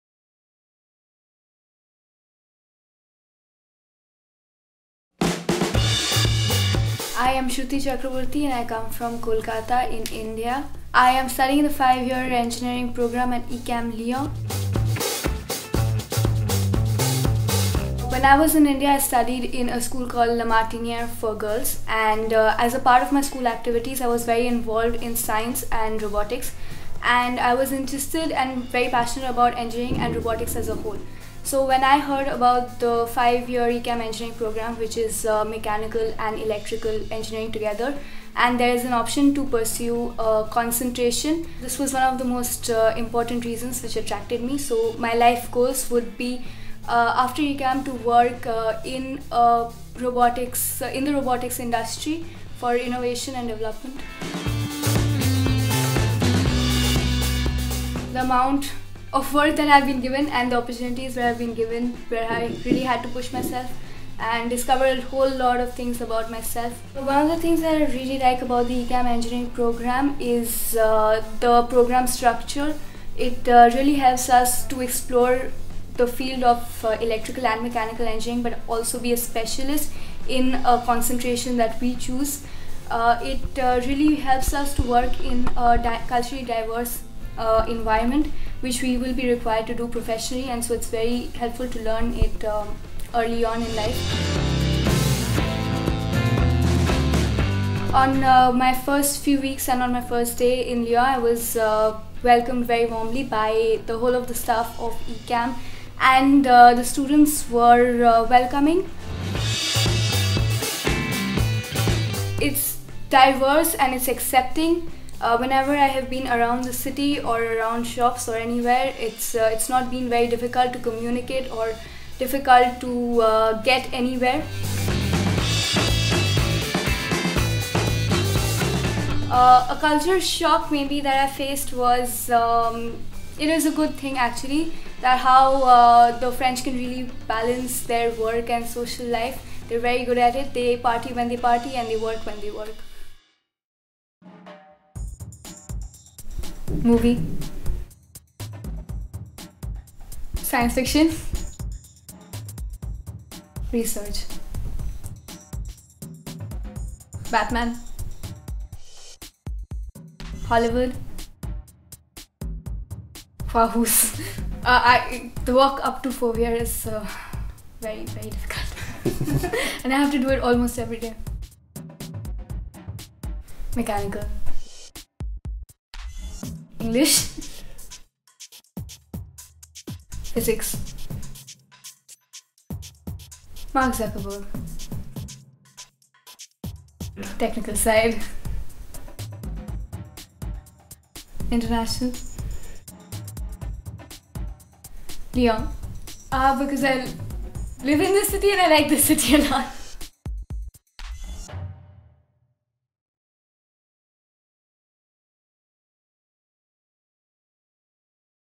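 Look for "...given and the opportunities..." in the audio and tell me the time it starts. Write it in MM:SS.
00:59.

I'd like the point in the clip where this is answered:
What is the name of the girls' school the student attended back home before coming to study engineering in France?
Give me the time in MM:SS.
00:20.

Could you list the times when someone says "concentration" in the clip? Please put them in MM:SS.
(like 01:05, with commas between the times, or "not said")
00:40, 01:20.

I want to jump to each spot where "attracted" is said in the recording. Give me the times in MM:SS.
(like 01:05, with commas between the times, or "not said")
00:43.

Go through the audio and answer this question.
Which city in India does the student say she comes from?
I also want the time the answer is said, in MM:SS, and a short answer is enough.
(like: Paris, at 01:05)
Kolkata, at 00:09.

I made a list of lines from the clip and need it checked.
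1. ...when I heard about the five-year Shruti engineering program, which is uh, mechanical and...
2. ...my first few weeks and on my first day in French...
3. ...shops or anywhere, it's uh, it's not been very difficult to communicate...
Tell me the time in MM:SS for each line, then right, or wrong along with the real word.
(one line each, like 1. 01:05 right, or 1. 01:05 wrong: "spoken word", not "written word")
1. 00:31 wrong: "ECAM", not "Shruti"
2. 01:38 wrong: "Lyon", not "French"
3. 01:57 right.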